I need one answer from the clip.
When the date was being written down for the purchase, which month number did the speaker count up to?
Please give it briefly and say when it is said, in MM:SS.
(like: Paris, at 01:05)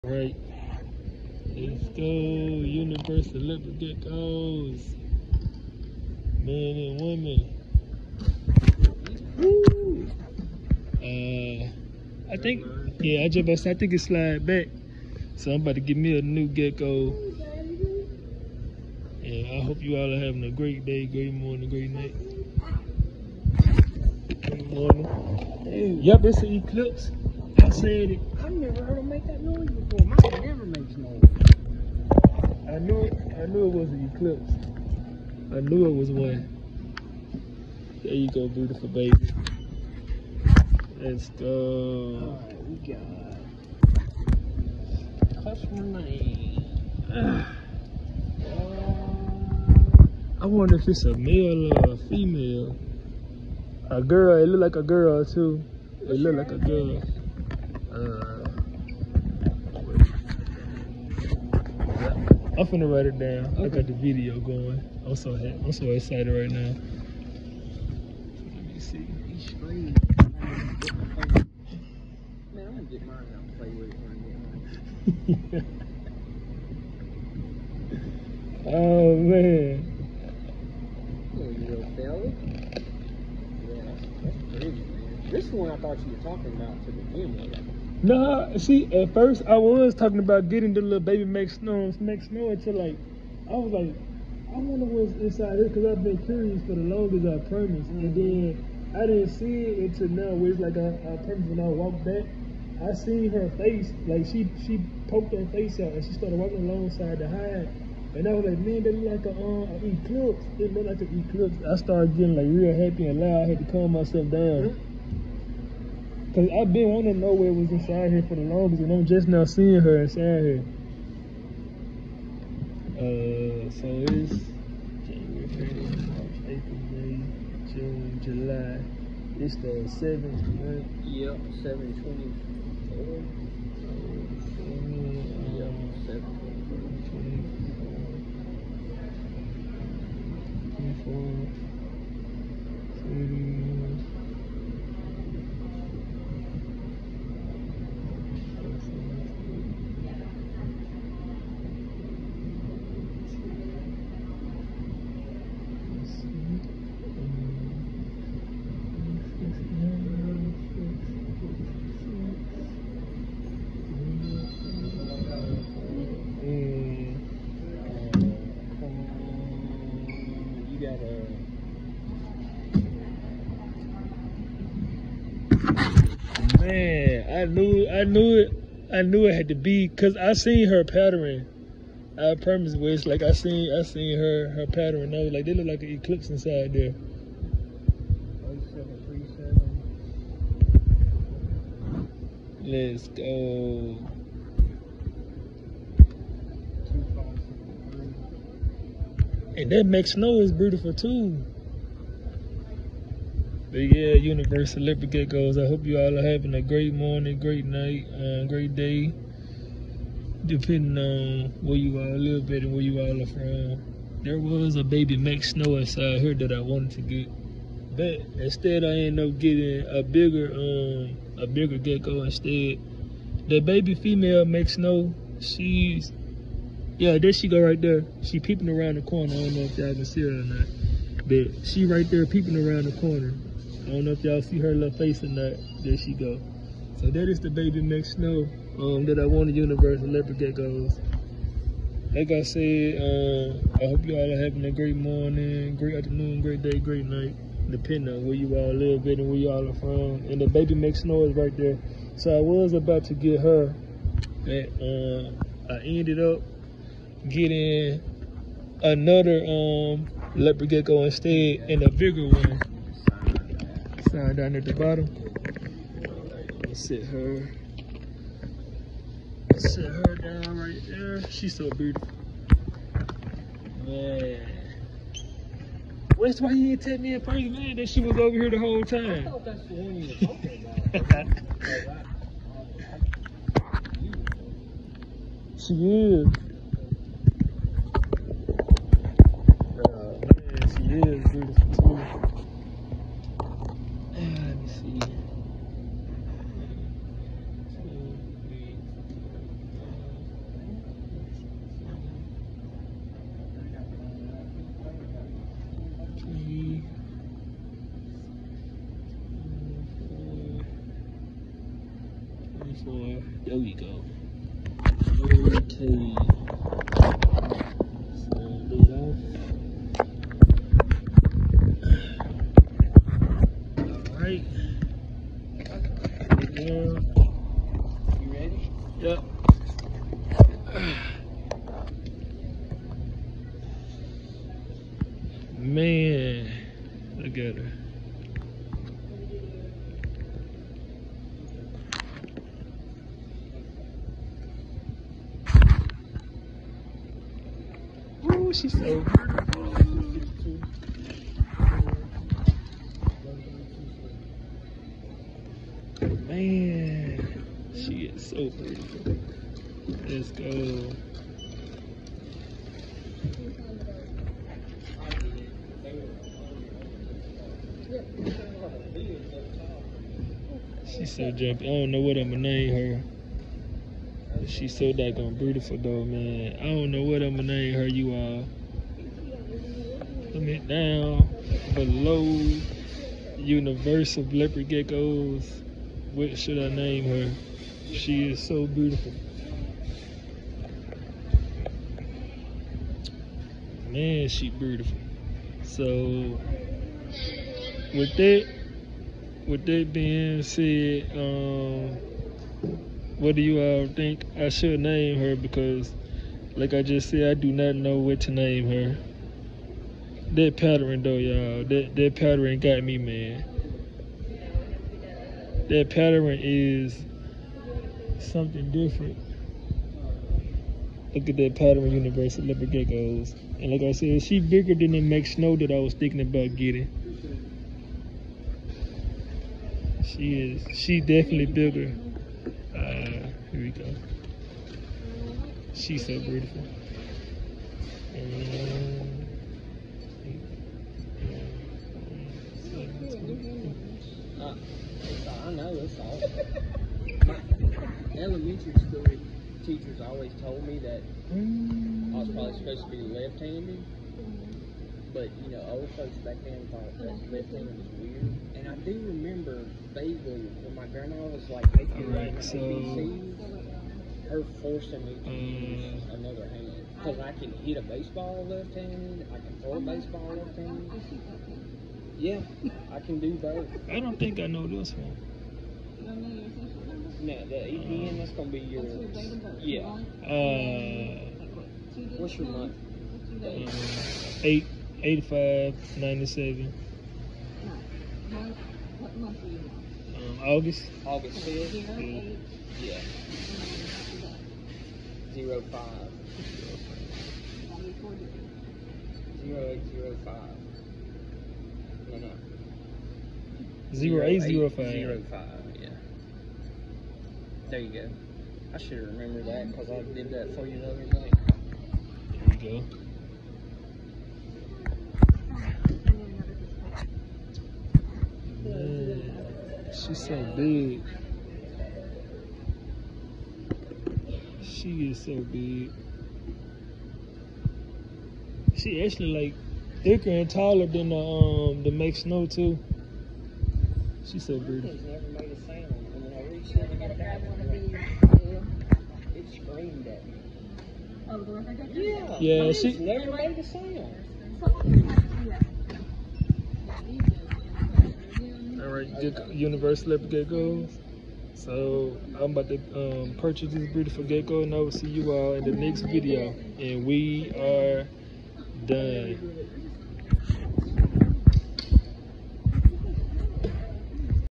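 Seventh, at 02:09.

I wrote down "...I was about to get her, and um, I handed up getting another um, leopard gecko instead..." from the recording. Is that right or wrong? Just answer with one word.
wrong.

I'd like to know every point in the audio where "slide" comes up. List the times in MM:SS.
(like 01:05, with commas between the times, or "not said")
00:14.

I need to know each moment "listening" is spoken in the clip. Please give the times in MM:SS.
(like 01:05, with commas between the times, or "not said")
07:37.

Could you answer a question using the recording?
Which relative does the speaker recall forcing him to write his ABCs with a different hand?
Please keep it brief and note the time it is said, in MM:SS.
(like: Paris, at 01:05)
Grandma, at 07:40.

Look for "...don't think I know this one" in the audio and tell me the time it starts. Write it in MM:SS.
07:53.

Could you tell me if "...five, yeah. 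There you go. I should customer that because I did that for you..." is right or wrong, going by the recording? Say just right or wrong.
wrong.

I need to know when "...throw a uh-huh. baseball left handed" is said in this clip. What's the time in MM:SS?
07:49.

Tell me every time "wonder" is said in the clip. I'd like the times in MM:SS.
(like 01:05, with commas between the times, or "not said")
00:50, 01:34.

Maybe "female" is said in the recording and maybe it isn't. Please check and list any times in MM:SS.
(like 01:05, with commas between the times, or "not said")
00:52, 03:43.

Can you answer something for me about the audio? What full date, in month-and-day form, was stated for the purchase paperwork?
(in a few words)
7/24.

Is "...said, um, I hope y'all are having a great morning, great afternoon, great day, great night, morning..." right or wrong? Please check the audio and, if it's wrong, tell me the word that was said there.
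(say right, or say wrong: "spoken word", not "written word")
wrong: "depending", not "morning".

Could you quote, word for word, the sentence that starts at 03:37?
But instead I ended up getting a bigger um a bigger gecko instead.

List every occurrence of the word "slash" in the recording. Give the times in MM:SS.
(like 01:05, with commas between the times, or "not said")
not said.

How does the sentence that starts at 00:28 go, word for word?
I've never heard him make that noise before.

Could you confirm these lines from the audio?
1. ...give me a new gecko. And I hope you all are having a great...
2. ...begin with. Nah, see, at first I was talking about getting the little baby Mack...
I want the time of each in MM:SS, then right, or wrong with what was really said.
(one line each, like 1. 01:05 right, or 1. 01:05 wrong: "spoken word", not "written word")
1. 00:15 right
2. 01:26 right.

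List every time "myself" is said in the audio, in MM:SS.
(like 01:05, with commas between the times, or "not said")
01:53.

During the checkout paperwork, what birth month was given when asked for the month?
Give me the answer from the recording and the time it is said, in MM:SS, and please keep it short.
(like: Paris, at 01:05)
August, at 08:09.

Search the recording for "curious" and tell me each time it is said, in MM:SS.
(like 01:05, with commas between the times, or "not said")
01:36.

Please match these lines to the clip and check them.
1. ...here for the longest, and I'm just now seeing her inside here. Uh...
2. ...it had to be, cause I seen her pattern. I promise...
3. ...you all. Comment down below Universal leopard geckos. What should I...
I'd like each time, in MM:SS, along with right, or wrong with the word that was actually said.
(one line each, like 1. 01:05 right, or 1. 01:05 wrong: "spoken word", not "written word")
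1. 01:58 right
2. 02:59 right
3. 06:17 right.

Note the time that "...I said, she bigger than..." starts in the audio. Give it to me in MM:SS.
07:03.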